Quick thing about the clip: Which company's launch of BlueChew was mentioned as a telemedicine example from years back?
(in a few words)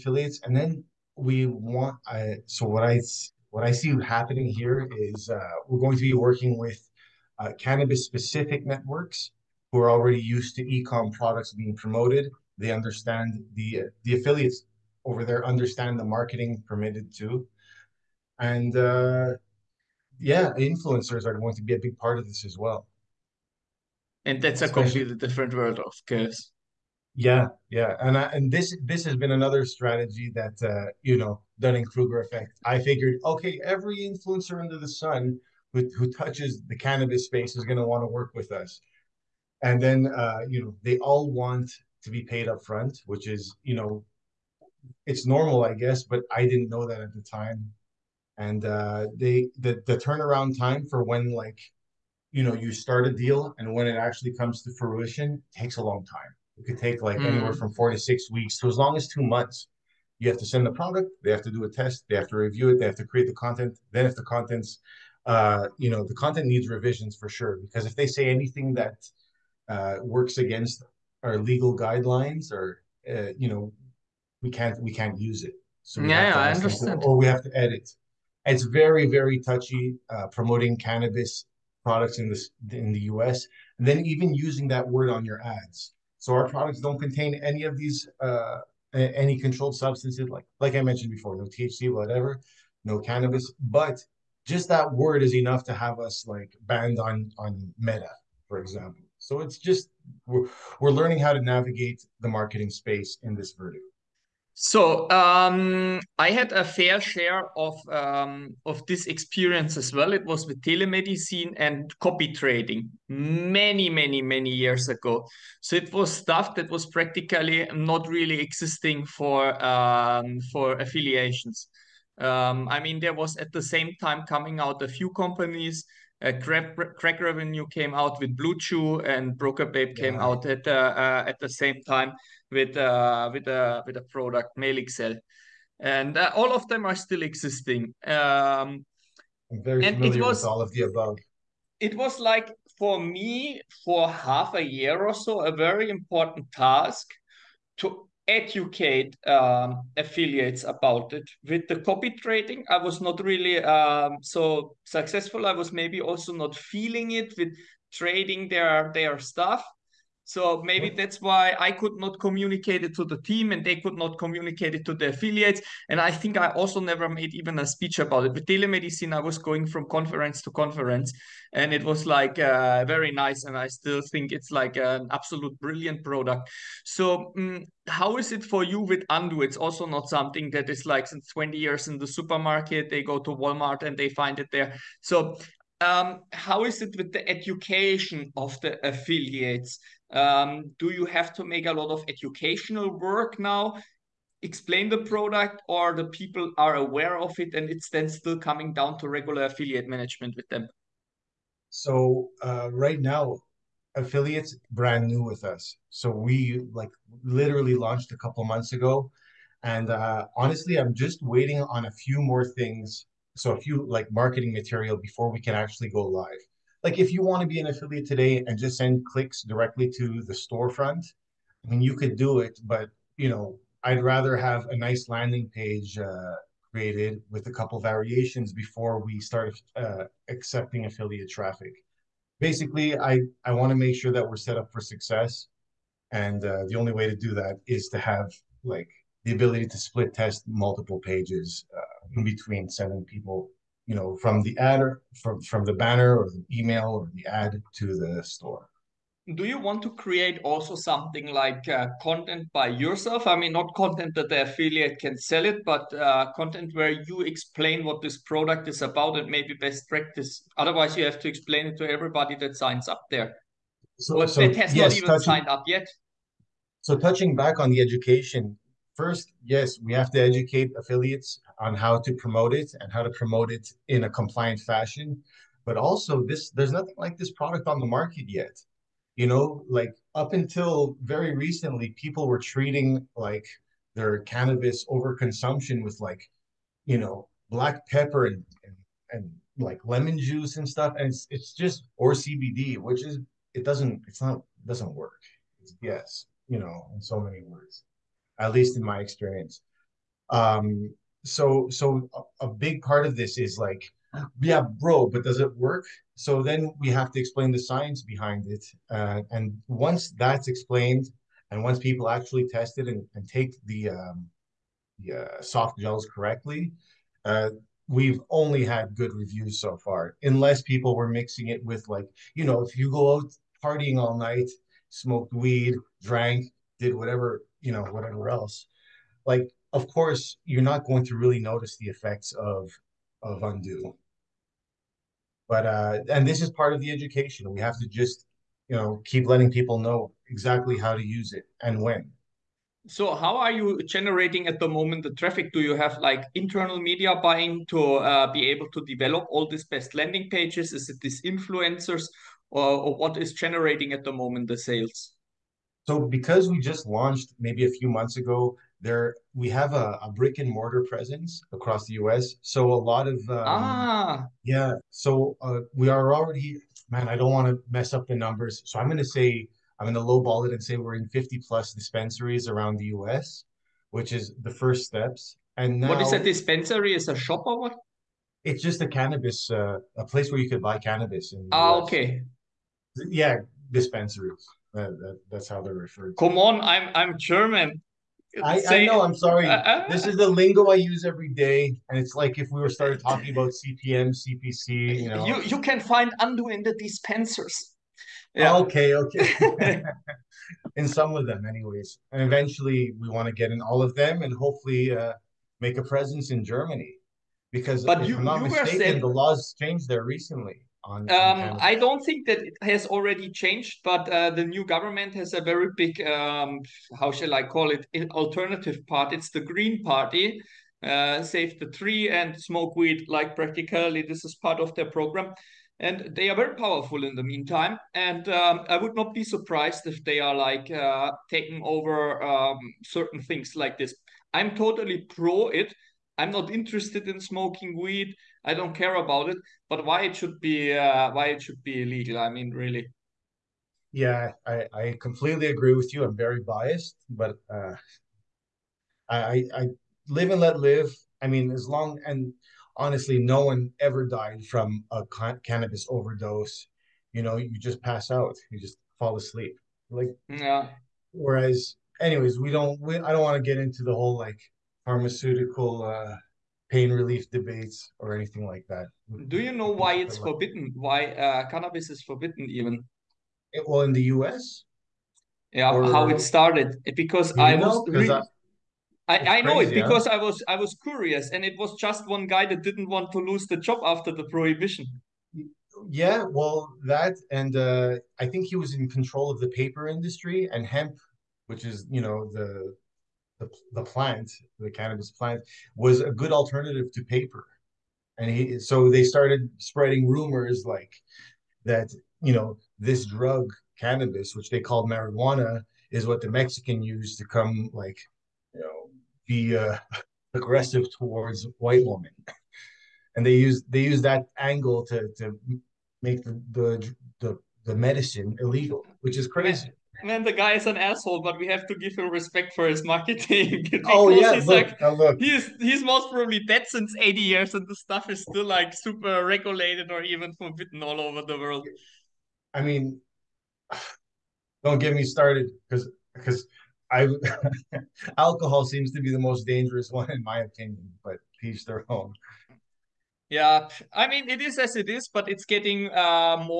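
crack revenue.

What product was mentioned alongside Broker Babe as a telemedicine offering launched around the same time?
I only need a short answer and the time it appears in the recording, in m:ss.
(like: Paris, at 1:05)
Male Excel, at 2:14.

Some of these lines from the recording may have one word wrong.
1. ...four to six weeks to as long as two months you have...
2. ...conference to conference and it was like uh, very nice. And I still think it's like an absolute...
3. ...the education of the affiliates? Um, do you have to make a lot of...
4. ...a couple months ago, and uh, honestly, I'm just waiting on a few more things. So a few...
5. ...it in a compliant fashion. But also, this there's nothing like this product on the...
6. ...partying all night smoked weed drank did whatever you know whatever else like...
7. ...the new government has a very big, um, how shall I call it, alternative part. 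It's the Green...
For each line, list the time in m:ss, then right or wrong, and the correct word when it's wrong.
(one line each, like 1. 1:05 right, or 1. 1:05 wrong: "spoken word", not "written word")
1. 0:57 right
2. 2:49 right
3. 3:07 right
4. 3:28 right
5. 4:33 right
6. 5:23 right
7. 6:54 right.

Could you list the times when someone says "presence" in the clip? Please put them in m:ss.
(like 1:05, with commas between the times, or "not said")
6:00, 6:45.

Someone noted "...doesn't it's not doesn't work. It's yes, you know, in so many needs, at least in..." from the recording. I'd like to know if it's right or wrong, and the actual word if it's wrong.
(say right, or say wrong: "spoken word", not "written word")
wrong: "words", not "needs".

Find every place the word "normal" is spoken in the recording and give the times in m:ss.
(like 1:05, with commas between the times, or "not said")
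0:45.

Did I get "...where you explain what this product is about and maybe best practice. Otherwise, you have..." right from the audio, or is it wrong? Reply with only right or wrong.
right.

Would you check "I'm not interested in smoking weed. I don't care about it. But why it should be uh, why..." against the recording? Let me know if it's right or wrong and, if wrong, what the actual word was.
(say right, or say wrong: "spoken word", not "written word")
right.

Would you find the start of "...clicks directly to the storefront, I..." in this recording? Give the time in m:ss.
3:39.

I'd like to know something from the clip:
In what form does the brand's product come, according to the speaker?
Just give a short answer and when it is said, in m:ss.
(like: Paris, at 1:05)
soft gels, at 5:15.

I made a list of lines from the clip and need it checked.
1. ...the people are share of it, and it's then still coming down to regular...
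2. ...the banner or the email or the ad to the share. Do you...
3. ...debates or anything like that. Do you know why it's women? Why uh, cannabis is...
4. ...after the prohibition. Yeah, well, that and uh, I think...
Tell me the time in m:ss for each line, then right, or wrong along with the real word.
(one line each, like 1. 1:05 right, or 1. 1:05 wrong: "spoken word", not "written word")
1. 3:15 wrong: "aware", not "share"
2. 4:05 wrong: "store", not "share"
3. 7:47 wrong: "forbidden", not "women"
4. 8:03 right.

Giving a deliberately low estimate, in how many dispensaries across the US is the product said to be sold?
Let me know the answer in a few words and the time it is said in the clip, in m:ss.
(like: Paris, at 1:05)
50 plus, at 6:11.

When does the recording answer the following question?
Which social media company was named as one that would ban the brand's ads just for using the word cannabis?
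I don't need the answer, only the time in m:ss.
1:37.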